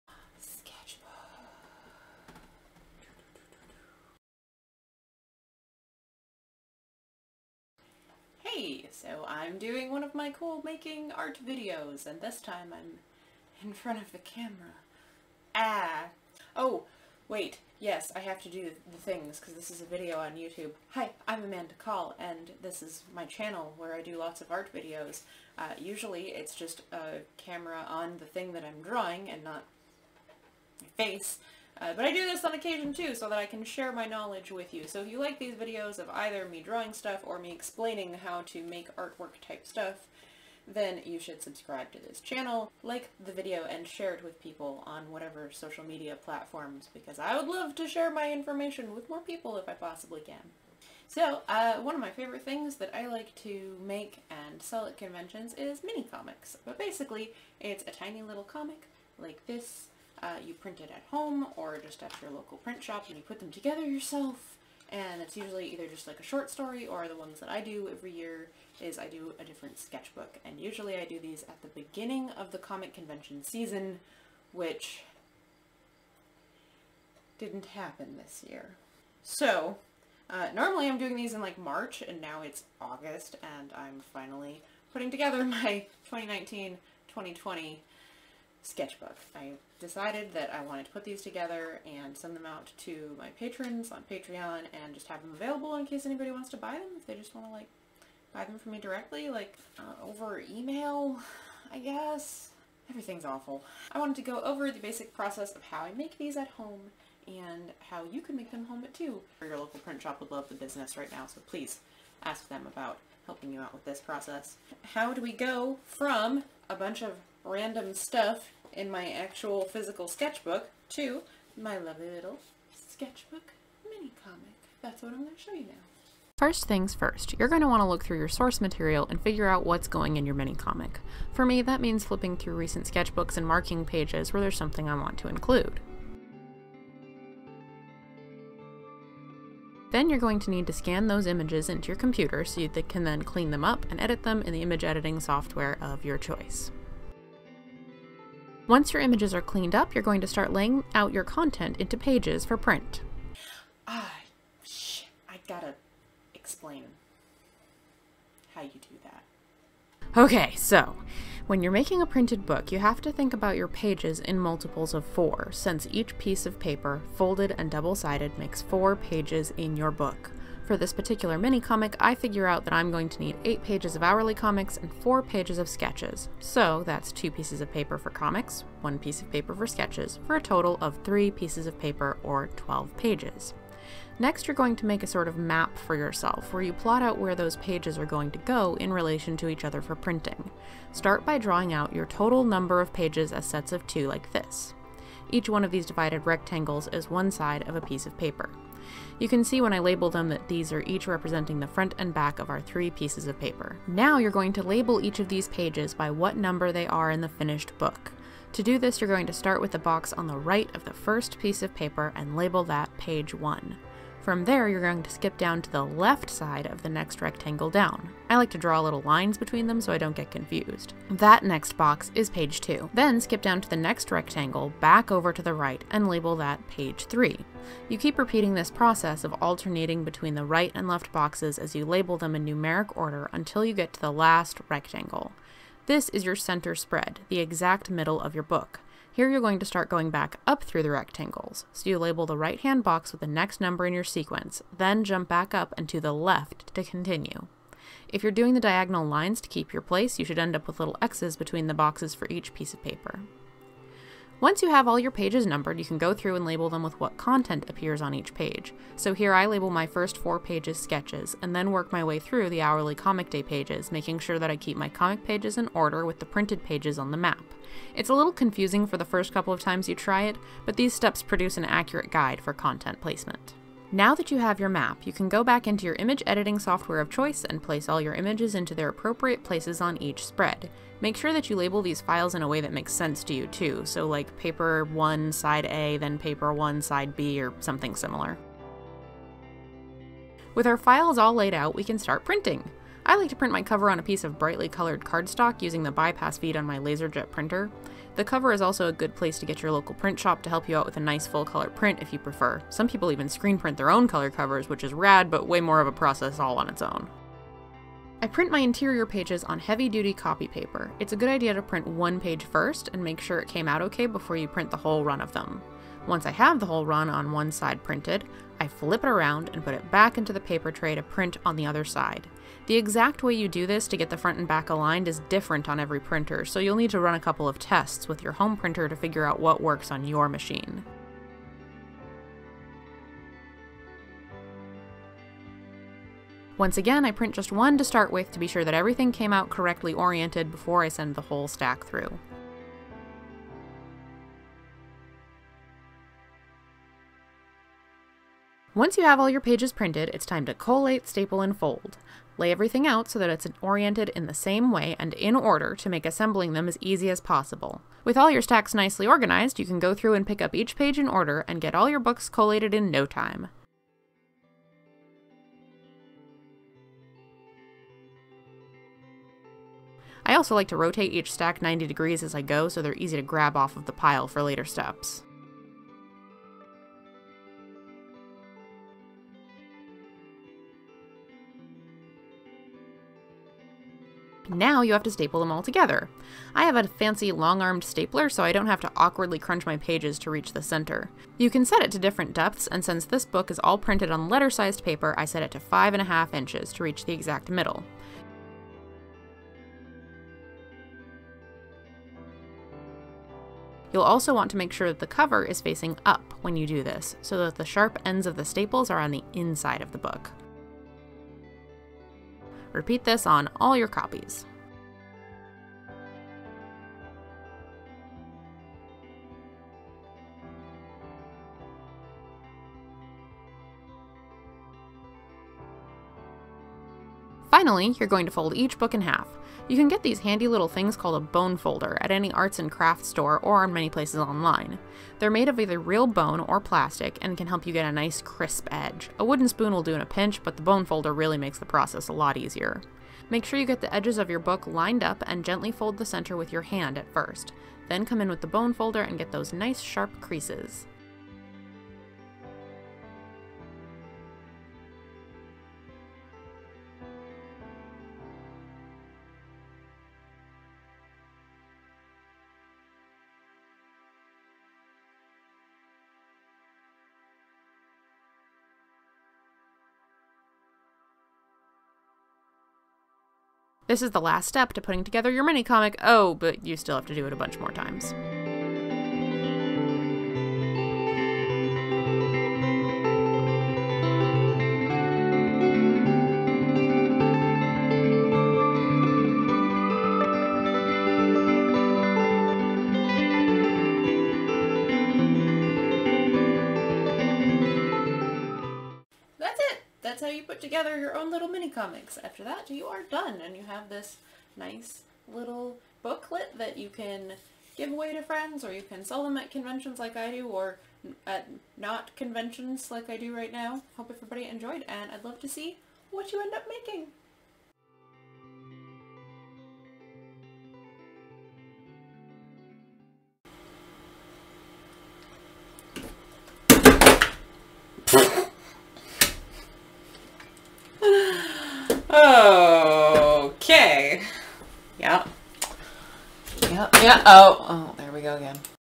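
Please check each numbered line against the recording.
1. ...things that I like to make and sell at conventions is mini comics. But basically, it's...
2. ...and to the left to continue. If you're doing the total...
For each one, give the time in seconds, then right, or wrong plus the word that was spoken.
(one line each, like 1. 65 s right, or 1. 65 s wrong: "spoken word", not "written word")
1. 52 s right
2. 245 s wrong: "diagonal", not "total".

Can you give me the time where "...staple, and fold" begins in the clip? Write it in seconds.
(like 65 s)
351 s.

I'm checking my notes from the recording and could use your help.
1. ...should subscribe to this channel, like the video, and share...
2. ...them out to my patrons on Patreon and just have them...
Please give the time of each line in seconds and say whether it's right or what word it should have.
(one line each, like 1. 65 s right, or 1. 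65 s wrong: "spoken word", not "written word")
1. 41 s right
2. 92 s right.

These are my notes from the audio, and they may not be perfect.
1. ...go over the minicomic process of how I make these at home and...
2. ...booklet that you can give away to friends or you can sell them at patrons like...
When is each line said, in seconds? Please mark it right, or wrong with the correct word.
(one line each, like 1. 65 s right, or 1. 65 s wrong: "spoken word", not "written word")
1. 104 s wrong: "basic", not "minicomic"
2. 506 s wrong: "conventions", not "patrons".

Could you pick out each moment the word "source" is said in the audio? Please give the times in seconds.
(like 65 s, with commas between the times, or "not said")
128 s.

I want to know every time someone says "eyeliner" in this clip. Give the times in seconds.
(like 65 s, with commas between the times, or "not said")
not said.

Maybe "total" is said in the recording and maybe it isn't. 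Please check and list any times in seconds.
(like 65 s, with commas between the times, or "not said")
180 s, 192 s.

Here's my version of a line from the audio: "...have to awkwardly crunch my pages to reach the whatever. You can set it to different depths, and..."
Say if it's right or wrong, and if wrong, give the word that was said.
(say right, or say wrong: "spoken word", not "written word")
wrong: "center", not "whatever".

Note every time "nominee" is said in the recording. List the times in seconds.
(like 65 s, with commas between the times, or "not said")
not said.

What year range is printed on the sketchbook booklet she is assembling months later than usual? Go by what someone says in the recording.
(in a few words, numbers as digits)
2019-2020.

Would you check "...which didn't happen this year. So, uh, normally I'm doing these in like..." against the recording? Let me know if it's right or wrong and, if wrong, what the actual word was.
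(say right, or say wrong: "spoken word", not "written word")
right.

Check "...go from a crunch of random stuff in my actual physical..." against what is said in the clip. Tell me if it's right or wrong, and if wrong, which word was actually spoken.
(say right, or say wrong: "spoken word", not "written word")
wrong: "bunch", not "crunch".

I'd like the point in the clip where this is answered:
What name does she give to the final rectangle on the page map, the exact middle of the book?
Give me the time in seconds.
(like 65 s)
236 s.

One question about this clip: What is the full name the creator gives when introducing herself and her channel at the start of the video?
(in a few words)
Amanda Kahl.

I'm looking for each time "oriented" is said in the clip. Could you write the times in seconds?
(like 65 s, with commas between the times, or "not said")
339 s, 353 s.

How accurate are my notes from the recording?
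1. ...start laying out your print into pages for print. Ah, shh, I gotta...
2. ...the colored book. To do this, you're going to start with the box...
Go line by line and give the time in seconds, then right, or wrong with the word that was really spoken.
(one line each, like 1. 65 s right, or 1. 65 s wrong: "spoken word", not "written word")
1. 150 s wrong: "content", not "print"
2. 207 s wrong: "finished", not "colored".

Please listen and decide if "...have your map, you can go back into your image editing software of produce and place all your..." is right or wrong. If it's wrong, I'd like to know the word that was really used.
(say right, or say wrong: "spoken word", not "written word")
wrong: "choice", not "produce".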